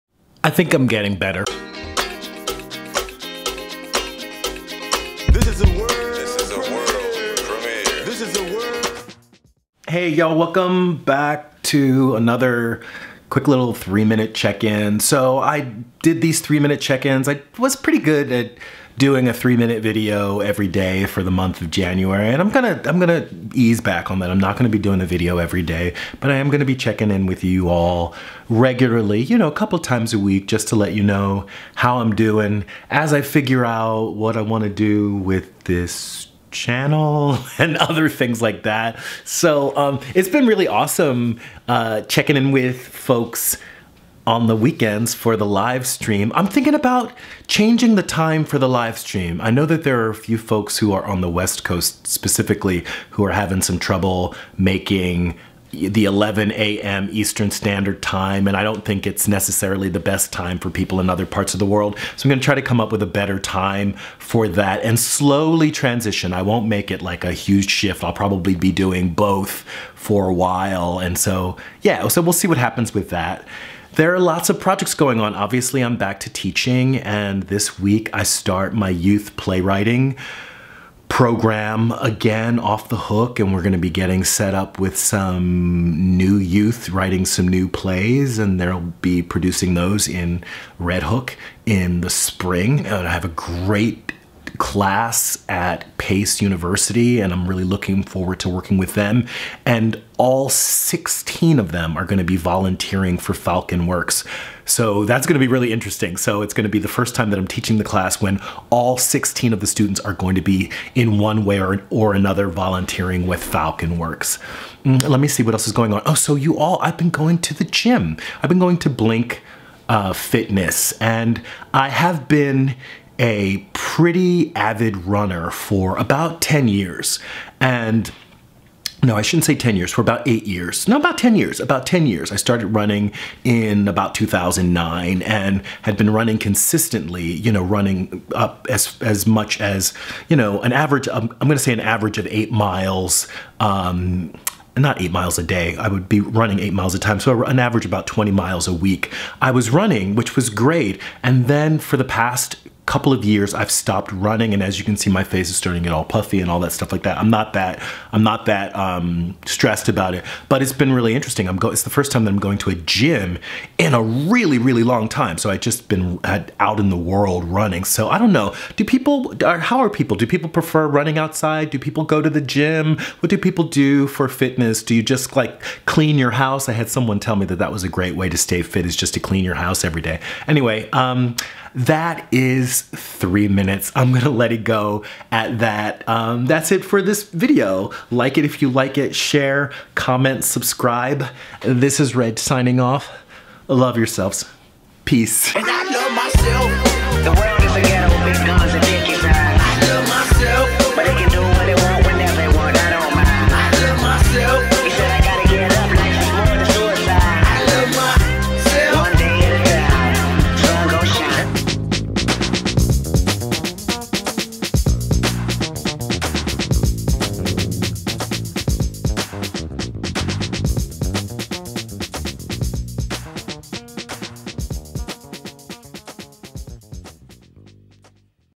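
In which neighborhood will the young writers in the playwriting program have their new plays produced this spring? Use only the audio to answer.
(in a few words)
Red Hook.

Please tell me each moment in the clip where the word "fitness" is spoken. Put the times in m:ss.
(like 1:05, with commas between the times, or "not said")
2:00, 2:54.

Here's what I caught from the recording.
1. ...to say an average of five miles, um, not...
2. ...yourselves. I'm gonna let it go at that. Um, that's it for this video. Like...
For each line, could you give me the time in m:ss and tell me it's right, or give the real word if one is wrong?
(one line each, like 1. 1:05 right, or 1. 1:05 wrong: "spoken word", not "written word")
1. 2:21 wrong: "eight", not "five"
2. 3:03 wrong: "minutes", not "yourselves".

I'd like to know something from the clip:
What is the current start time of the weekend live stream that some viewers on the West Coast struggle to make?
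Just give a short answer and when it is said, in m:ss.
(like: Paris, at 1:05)
11 a.m. Eastern, at 0:56.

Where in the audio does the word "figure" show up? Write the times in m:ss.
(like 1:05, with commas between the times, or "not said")
0:33.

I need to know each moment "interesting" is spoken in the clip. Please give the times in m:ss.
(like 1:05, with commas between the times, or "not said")
1:45, 2:41.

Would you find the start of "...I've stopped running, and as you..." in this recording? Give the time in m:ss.
2:33.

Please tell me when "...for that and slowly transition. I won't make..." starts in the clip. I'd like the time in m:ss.
1:04.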